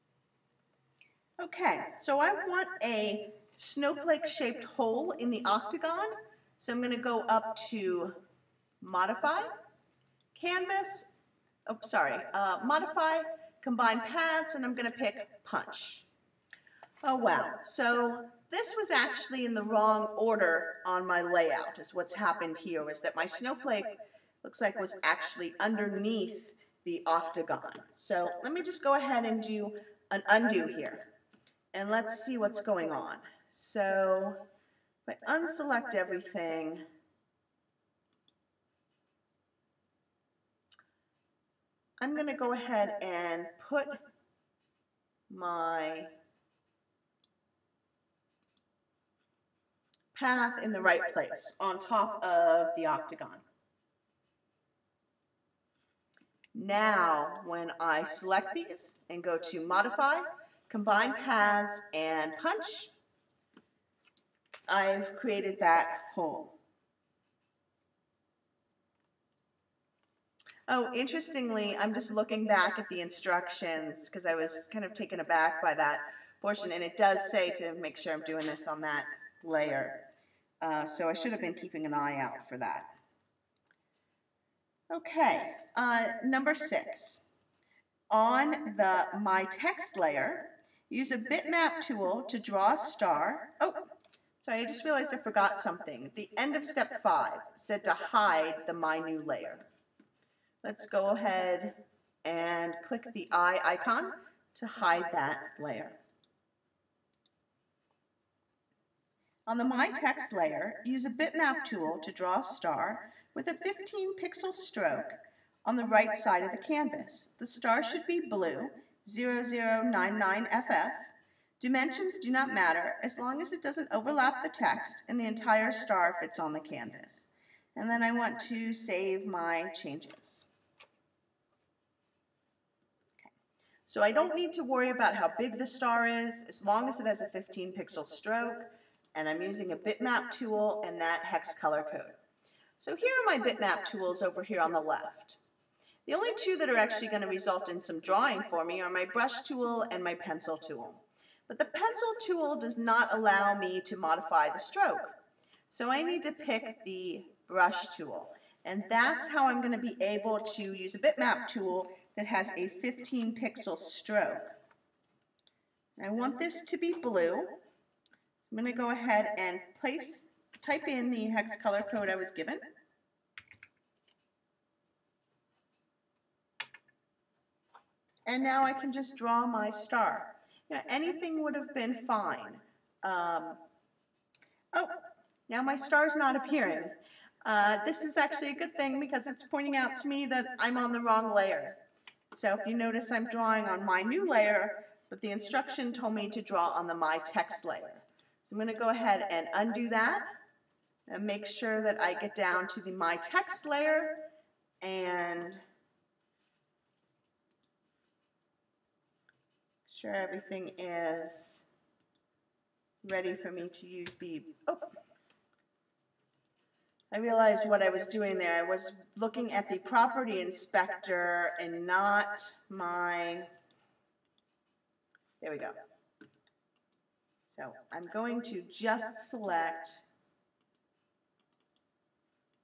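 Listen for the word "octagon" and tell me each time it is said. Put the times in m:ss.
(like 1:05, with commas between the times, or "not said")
0:05, 0:27, 0:52.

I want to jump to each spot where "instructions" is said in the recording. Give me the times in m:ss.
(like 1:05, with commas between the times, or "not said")
1:13, 3:15.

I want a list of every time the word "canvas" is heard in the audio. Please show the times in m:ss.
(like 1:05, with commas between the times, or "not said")
0:10, 1:56, 2:06.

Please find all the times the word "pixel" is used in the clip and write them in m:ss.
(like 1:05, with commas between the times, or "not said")
1:54, 2:17, 2:43.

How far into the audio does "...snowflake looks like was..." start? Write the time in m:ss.
0:23.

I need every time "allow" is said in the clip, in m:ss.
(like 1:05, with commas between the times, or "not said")
2:33.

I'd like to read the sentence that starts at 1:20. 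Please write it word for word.
Uh, so I should have been keeping an eye out for that.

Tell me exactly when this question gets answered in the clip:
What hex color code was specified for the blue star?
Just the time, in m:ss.
1:59.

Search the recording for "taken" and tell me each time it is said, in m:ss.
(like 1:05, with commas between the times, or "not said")
1:14.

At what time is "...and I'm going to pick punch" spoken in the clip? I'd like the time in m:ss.
0:14.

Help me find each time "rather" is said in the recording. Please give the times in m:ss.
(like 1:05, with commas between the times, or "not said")
not said.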